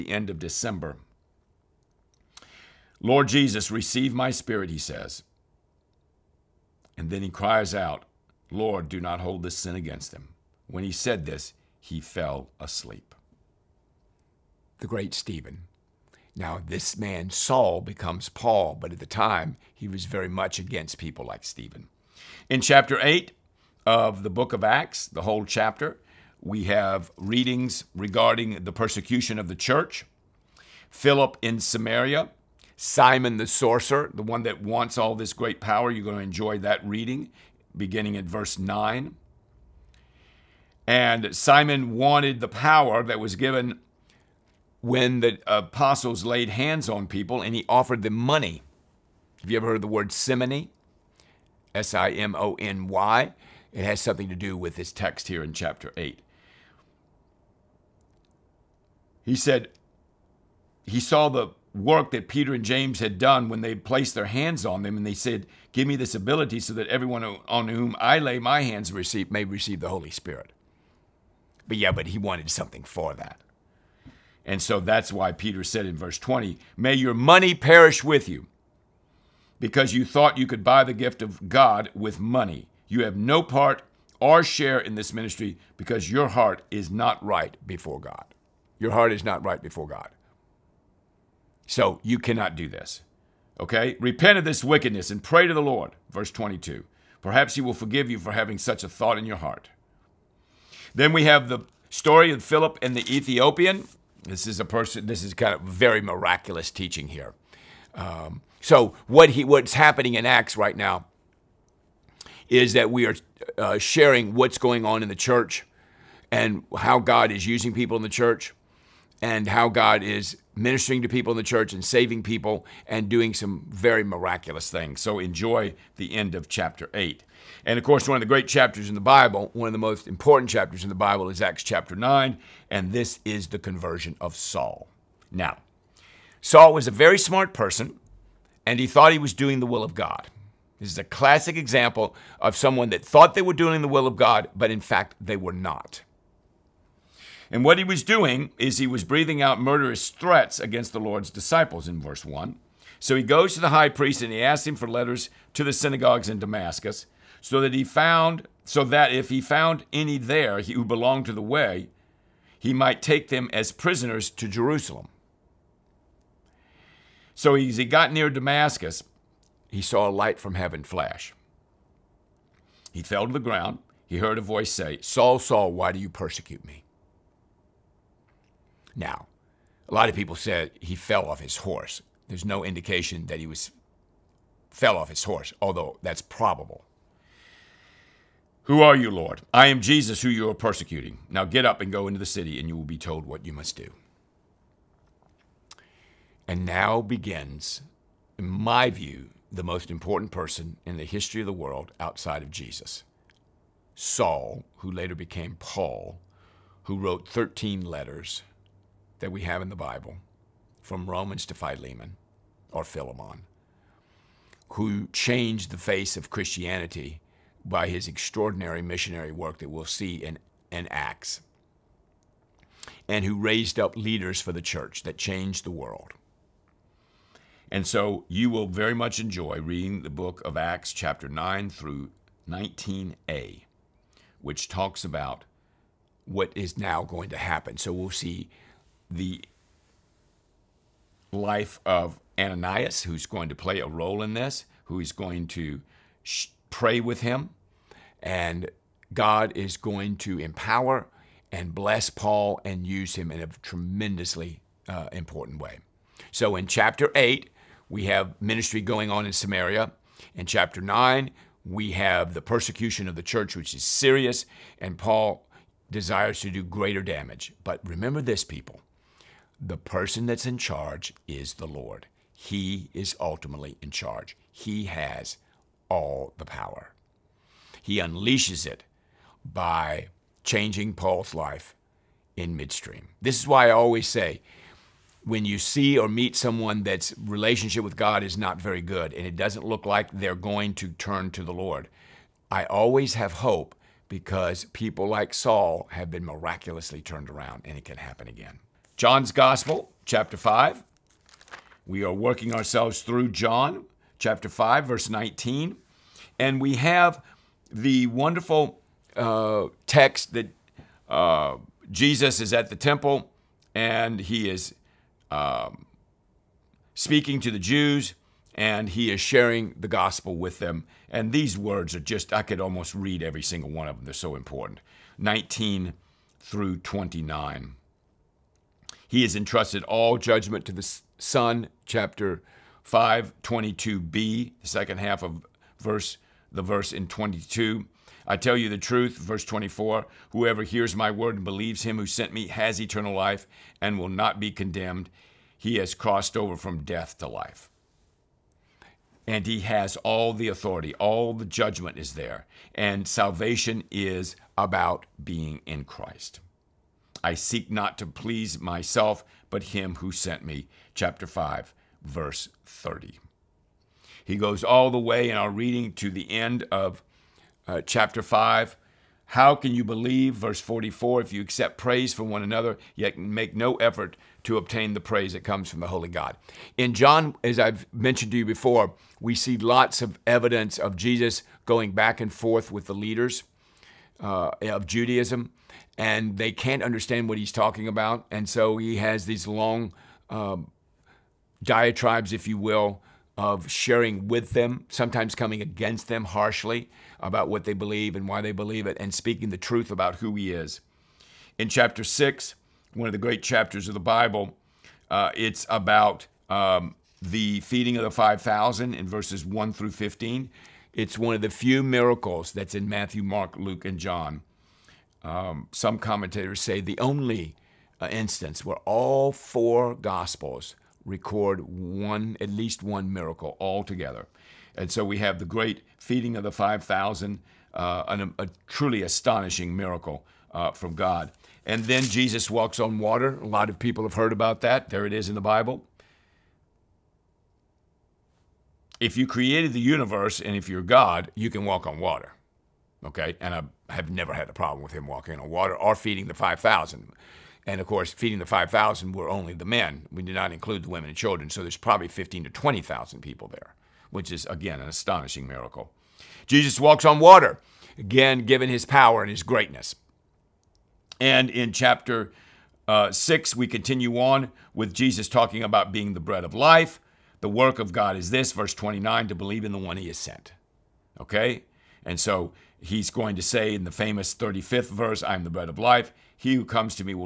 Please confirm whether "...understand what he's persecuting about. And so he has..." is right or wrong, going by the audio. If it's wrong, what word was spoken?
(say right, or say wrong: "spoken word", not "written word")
wrong: "talking", not "persecuting".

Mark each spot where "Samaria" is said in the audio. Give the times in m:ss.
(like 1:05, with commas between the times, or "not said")
0:31, 4:19.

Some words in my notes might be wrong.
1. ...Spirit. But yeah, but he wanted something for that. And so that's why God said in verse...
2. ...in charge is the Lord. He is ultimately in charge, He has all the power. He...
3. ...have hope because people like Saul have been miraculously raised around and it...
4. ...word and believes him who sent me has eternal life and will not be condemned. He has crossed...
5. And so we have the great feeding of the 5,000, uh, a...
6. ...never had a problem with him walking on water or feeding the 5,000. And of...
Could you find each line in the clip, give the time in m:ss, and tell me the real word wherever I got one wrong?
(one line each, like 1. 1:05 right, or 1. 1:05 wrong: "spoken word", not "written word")
1. 1:10 wrong: "Peter", not "God"
2. 4:30 right
3. 4:53 wrong: "turned", not "raised"
4. 5:41 right
5. 7:04 right
6. 7:24 right.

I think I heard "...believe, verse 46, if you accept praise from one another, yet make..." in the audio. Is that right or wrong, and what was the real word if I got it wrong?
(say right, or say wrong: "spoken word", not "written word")
wrong: "44", not "46".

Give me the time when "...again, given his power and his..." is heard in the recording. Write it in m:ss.
7:37.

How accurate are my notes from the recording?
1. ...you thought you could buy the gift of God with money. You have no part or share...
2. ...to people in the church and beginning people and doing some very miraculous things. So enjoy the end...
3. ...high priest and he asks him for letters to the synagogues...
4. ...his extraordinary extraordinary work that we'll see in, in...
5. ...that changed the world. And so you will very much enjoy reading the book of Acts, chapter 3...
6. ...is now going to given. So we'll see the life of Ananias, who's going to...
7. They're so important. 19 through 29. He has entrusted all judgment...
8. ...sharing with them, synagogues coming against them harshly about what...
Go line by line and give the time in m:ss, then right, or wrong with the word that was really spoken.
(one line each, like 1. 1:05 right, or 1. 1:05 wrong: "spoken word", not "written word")
1. 1:19 right
2. 2:01 wrong: "saving", not "beginning"
3. 2:33 right
4. 3:37 wrong: "missionary", not "extraordinary"
5. 3:45 wrong: "9", not "3"
6. 3:56 wrong: "happen", not "given"
7. 5:24 right
8. 6:33 wrong: "sometimes", not "synagogues".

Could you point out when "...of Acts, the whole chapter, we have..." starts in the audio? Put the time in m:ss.
0:24.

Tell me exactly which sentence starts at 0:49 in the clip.
Have you ever heard the word simony?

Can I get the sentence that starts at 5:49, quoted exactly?
And he has all the authority, all the judgment is there.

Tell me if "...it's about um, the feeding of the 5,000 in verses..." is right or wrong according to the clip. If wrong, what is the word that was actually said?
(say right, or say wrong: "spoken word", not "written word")
right.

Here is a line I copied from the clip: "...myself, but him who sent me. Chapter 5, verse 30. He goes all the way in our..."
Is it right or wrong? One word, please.
right.